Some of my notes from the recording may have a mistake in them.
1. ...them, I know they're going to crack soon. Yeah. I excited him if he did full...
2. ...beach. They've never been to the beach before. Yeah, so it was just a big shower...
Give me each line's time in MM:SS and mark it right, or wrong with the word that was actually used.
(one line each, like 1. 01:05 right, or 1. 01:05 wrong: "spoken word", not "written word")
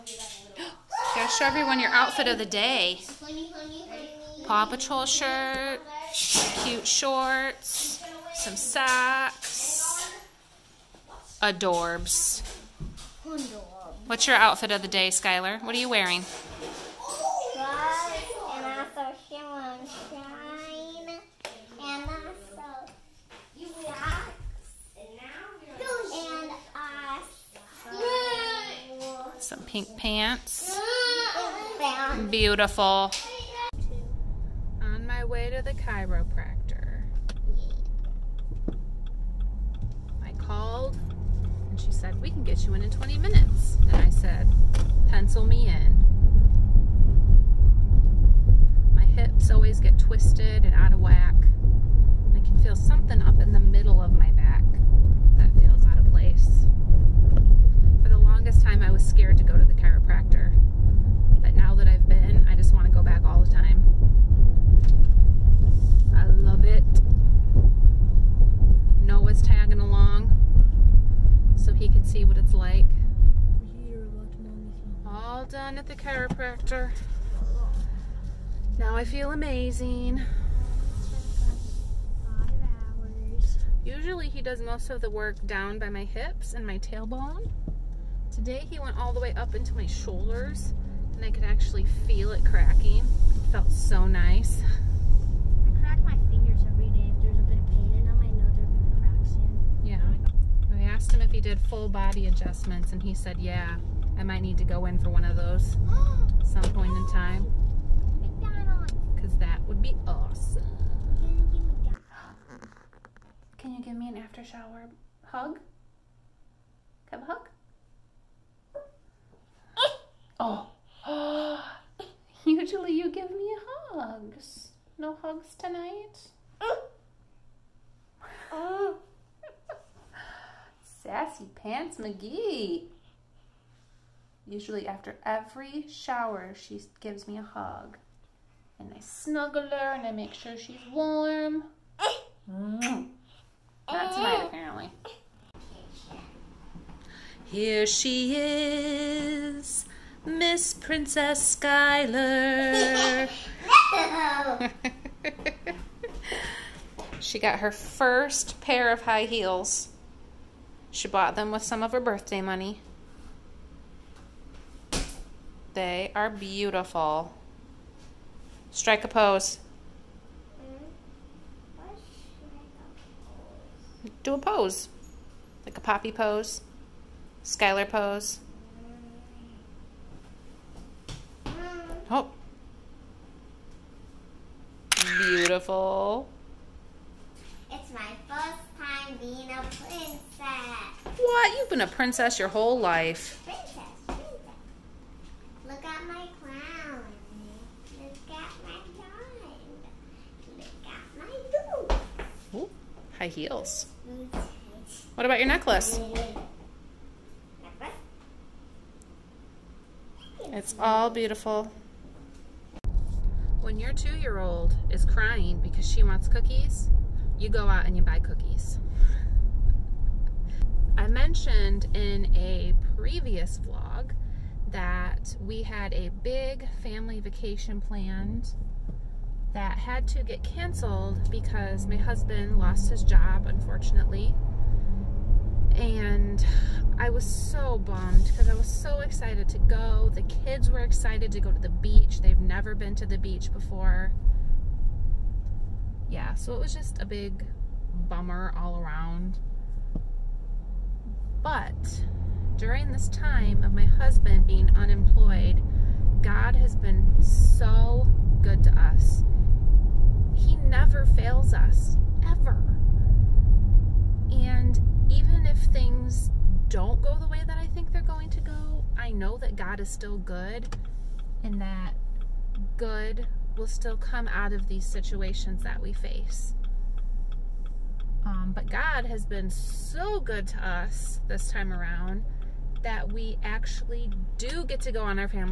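1. 01:38 wrong: "asked", not "excited"
2. 04:01 wrong: "bummer", not "shower".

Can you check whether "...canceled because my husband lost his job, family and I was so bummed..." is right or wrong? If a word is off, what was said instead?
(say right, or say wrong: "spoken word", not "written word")
wrong: "unfortunately", not "family".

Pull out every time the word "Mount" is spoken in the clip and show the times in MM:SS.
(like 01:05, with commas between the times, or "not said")
not said.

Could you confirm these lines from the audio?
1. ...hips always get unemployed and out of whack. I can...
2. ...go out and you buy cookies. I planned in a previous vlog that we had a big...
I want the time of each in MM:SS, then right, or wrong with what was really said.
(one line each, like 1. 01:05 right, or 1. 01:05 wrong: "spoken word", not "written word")
1. 00:49 wrong: "twisted", not "unemployed"
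2. 03:37 wrong: "mentioned", not "planned".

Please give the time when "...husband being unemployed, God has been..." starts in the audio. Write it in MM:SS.
04:13.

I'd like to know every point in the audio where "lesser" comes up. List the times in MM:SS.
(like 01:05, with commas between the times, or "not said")
not said.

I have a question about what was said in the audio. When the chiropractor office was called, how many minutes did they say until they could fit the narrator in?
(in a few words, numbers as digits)
20.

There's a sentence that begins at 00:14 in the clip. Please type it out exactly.
What's your outfit of the day, Skylar?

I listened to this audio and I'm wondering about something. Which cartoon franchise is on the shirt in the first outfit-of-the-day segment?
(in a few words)
Paw Patrol.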